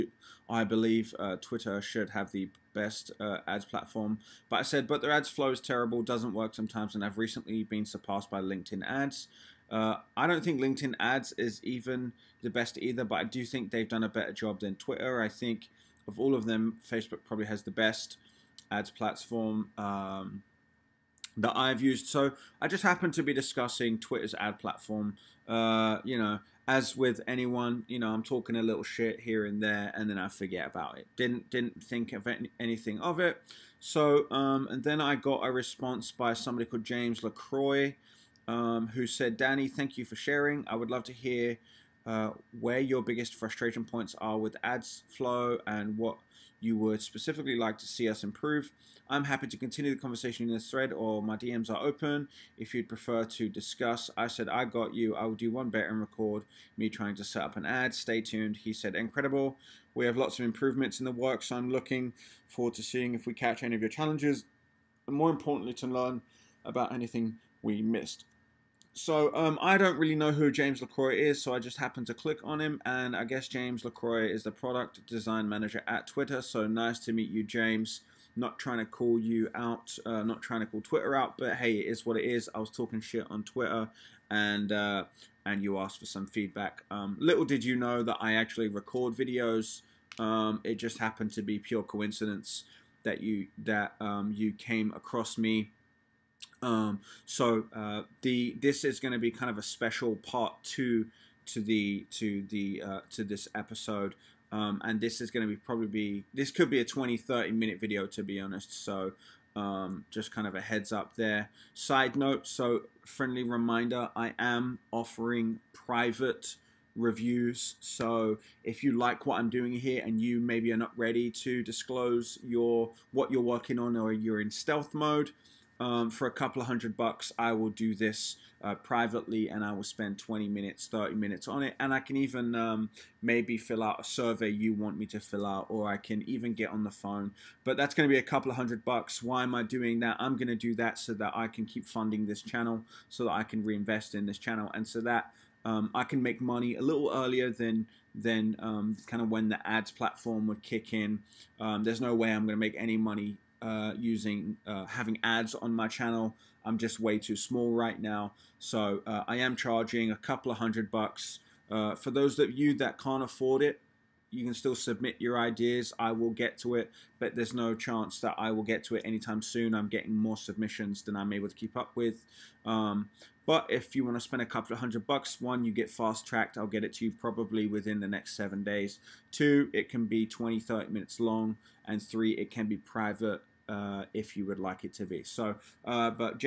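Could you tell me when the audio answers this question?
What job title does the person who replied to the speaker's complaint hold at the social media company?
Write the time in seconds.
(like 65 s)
74 s.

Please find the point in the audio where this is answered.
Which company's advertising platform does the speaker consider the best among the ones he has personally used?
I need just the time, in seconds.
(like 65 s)
16 s.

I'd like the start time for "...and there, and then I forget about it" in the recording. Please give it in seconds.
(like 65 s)
29 s.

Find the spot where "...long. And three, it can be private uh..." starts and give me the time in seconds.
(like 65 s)
181 s.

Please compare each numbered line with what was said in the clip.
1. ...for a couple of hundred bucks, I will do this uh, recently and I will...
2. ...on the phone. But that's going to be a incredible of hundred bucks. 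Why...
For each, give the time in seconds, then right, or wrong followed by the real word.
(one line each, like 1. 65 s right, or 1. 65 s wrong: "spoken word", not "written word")
1. 126 s wrong: "privately", not "recently"
2. 136 s wrong: "couple", not "incredible".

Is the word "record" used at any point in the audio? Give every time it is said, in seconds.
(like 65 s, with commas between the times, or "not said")
56 s, 88 s.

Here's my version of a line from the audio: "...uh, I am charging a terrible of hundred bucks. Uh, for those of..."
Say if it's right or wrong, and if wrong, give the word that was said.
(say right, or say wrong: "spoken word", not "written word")
wrong: "couple", not "terrible".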